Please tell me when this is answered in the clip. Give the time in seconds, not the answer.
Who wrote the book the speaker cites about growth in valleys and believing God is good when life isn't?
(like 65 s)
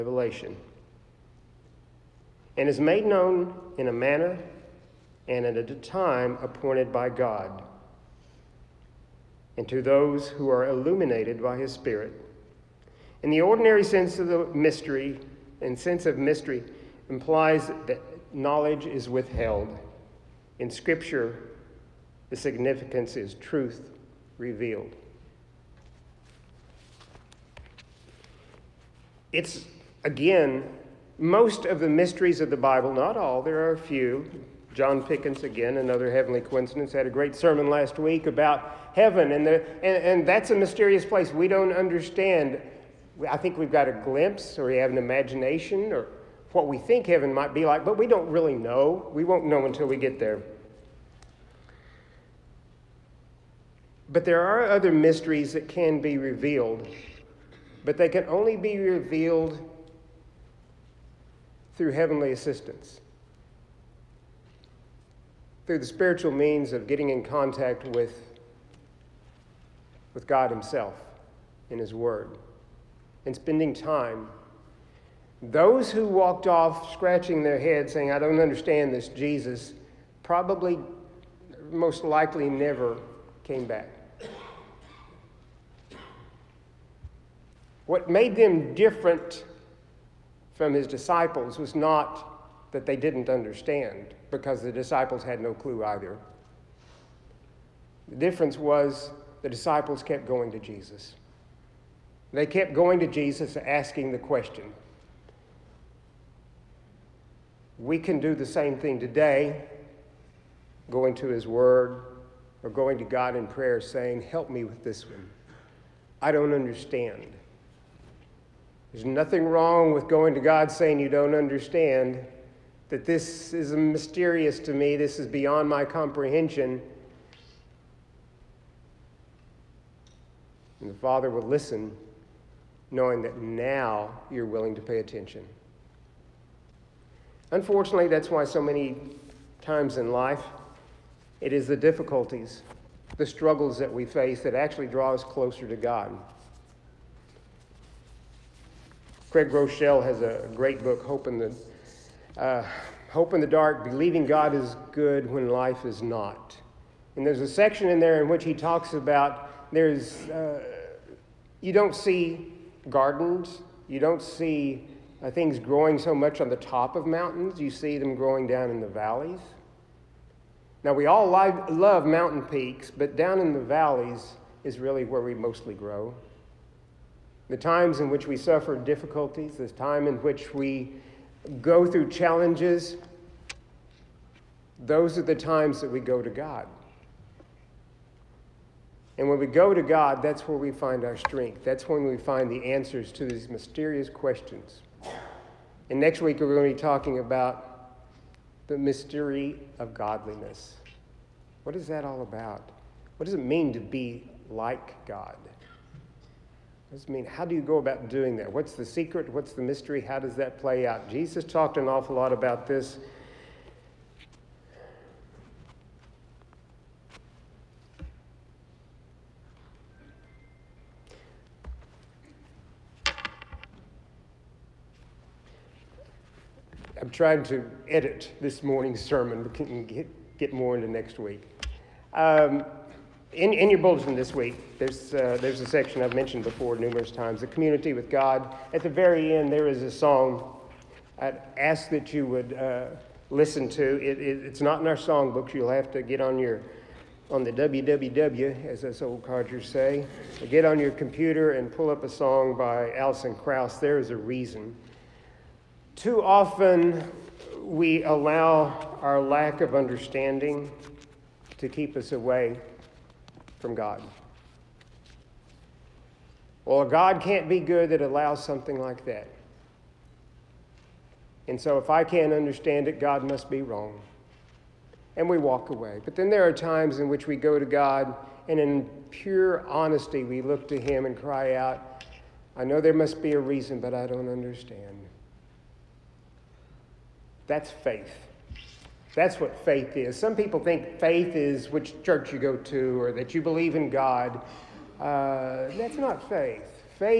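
149 s.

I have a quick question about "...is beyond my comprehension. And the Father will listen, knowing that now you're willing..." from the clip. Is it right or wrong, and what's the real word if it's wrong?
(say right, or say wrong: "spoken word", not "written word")
right.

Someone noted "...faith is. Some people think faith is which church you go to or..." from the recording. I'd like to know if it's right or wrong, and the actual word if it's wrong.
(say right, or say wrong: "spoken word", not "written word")
right.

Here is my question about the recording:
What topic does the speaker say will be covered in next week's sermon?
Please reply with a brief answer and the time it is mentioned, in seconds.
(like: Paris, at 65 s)
The mystery of godliness, at 198 s.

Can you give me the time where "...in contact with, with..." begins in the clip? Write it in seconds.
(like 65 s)
67 s.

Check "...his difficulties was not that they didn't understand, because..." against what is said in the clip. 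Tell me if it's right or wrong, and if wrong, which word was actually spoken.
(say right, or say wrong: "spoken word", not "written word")
wrong: "disciples", not "difficulties".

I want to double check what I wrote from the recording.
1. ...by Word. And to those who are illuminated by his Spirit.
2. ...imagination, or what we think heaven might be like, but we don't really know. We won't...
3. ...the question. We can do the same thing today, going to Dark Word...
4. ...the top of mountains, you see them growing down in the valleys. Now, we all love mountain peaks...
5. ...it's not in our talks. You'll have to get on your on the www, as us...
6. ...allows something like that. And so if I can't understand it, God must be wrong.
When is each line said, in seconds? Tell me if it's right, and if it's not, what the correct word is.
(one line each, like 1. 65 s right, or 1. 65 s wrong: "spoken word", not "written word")
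1. 6 s wrong: "God", not "Word"
2. 44 s right
3. 104 s wrong: "His", not "Dark"
4. 166 s right
5. 244 s wrong: "songbooks", not "talks"
6. 268 s right.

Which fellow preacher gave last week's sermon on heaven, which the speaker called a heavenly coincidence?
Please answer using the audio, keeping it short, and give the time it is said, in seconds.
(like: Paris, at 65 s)
John Pickens, at 34 s.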